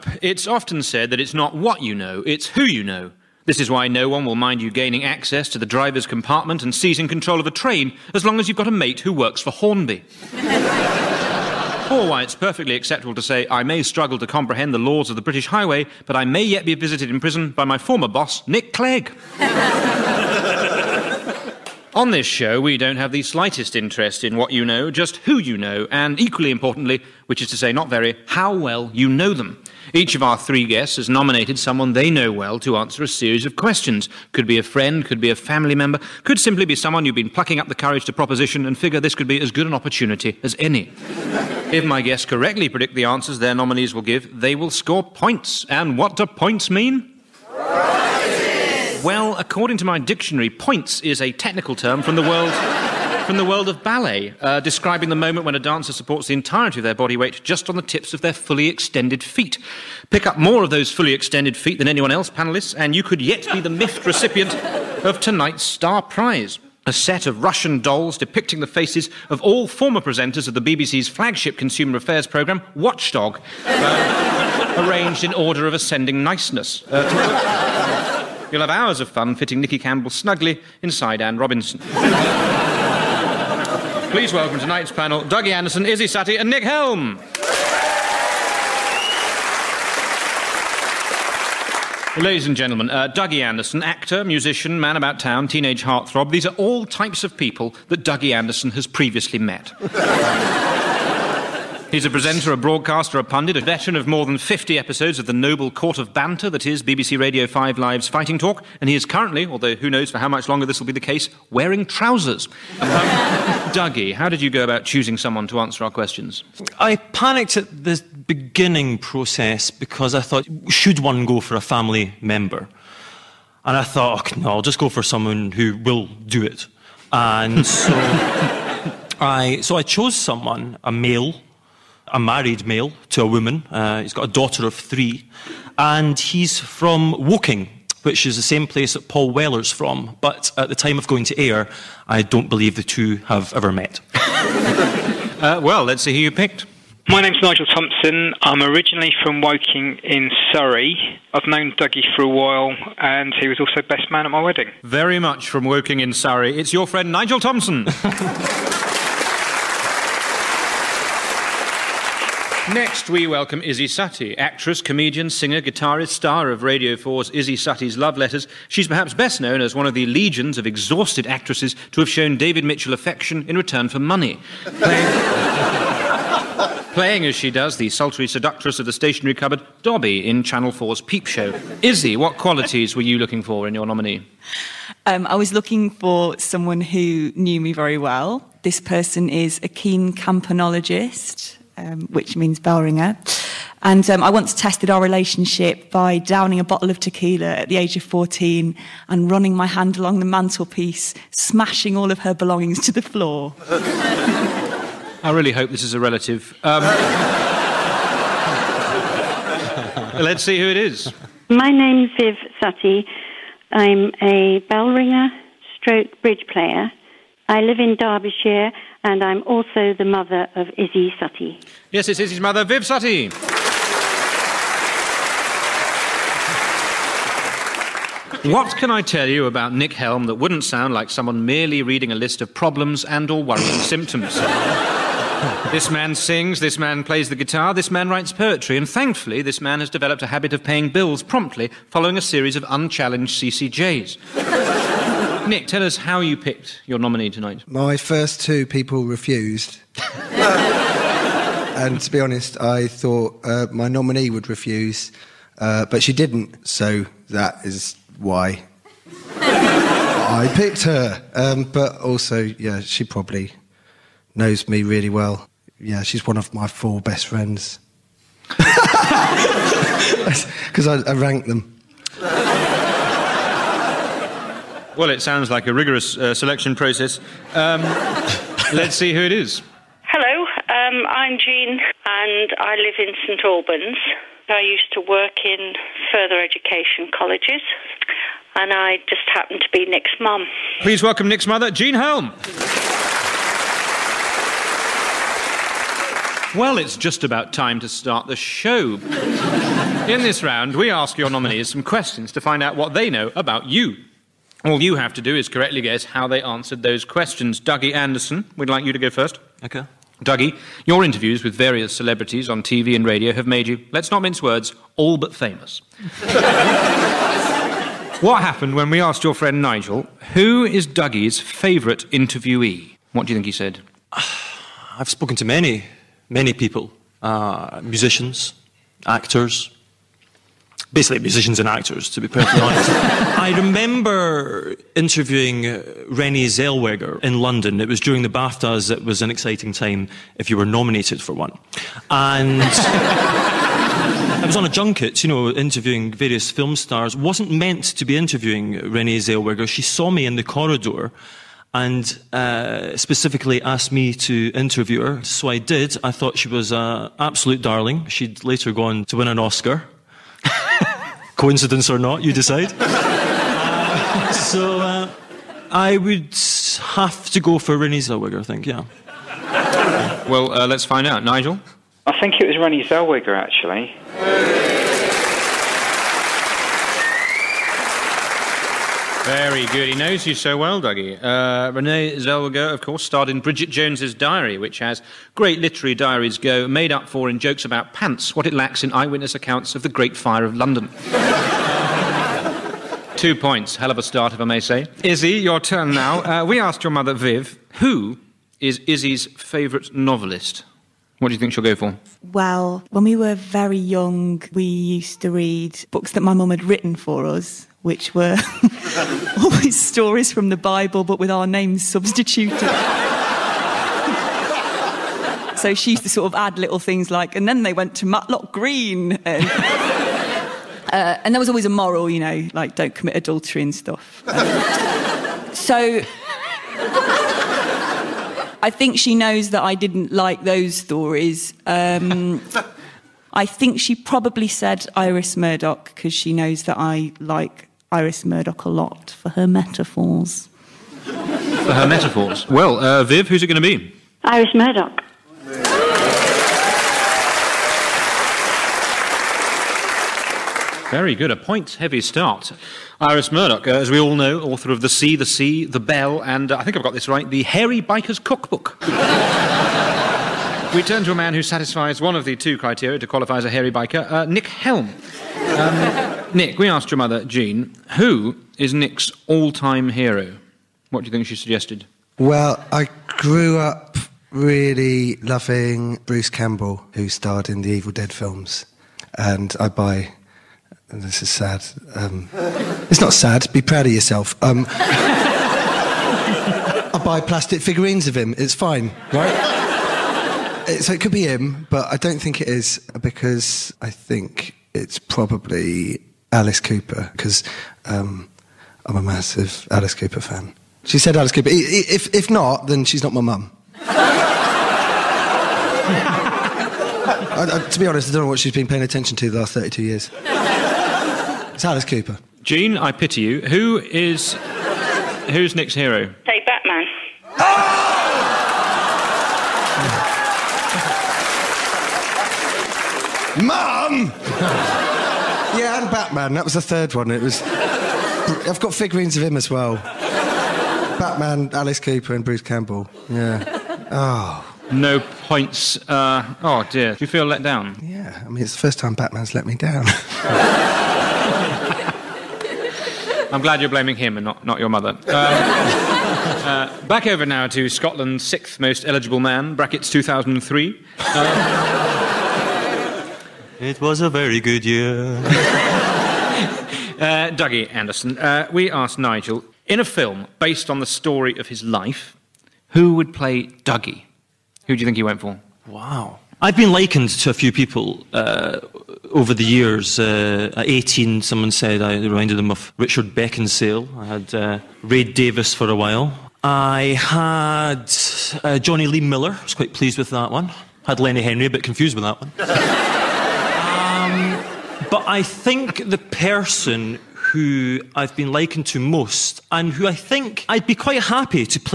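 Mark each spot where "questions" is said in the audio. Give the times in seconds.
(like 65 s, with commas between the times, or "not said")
33 s, 115 s, 301 s, 307 s.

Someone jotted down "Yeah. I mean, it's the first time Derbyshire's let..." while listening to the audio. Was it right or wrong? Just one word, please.
wrong.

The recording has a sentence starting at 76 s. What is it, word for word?
Uh, You'll have hours of fun fitting Nicky Campbell snugly inside Anne Robinson.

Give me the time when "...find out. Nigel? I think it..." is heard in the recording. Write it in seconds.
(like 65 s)
370 s.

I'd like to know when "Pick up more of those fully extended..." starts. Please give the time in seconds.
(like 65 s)
60 s.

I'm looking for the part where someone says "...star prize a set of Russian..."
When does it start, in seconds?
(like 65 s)
65 s.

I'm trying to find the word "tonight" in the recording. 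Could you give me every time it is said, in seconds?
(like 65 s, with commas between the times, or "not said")
65 s, 84 s, 247 s.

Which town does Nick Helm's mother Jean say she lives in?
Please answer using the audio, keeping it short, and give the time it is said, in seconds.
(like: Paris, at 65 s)
St Albans, at 283 s.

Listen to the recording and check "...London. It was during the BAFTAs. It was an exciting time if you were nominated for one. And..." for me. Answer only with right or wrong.
right.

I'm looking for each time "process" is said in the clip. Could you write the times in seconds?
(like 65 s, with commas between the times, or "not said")
118 s, 276 s.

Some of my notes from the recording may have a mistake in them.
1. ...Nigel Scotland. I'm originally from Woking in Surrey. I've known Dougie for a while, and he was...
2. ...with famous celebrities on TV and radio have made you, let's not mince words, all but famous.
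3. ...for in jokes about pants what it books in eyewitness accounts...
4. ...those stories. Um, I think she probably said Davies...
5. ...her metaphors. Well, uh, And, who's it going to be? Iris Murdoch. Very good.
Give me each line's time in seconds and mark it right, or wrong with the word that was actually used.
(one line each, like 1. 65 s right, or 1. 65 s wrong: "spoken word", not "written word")
1. 147 s wrong: "Thompson", not "Scotland"
2. 311 s wrong: "various", not "famous"
3. 387 s wrong: "lacks", not "books"
4. 430 s wrong: "Iris", not "Davies"
5. 441 s wrong: "Viv", not "And".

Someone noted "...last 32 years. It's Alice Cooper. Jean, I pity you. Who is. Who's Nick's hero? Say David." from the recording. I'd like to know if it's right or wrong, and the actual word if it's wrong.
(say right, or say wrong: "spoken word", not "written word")
wrong: "Batman", not "David".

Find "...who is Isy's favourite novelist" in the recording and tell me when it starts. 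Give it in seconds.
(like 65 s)
397 s.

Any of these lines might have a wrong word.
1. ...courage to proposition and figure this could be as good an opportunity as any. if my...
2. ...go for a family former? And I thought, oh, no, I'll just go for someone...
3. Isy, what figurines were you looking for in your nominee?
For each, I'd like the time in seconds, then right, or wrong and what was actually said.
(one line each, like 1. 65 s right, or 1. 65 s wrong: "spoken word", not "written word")
1. 37 s right
2. 121 s wrong: "member", not "former"
3. 181 s wrong: "qualities", not "figurines".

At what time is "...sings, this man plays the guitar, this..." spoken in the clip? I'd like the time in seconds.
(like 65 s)
236 s.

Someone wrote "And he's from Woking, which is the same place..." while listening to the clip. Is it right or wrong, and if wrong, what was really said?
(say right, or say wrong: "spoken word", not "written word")
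right.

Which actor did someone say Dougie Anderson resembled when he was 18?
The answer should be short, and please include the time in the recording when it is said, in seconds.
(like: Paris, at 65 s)
Richard Beckinsale, at 572 s.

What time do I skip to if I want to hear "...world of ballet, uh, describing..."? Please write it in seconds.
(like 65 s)
53 s.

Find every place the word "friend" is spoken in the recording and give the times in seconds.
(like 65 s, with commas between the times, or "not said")
34 s, 156 s, 267 s, 319 s.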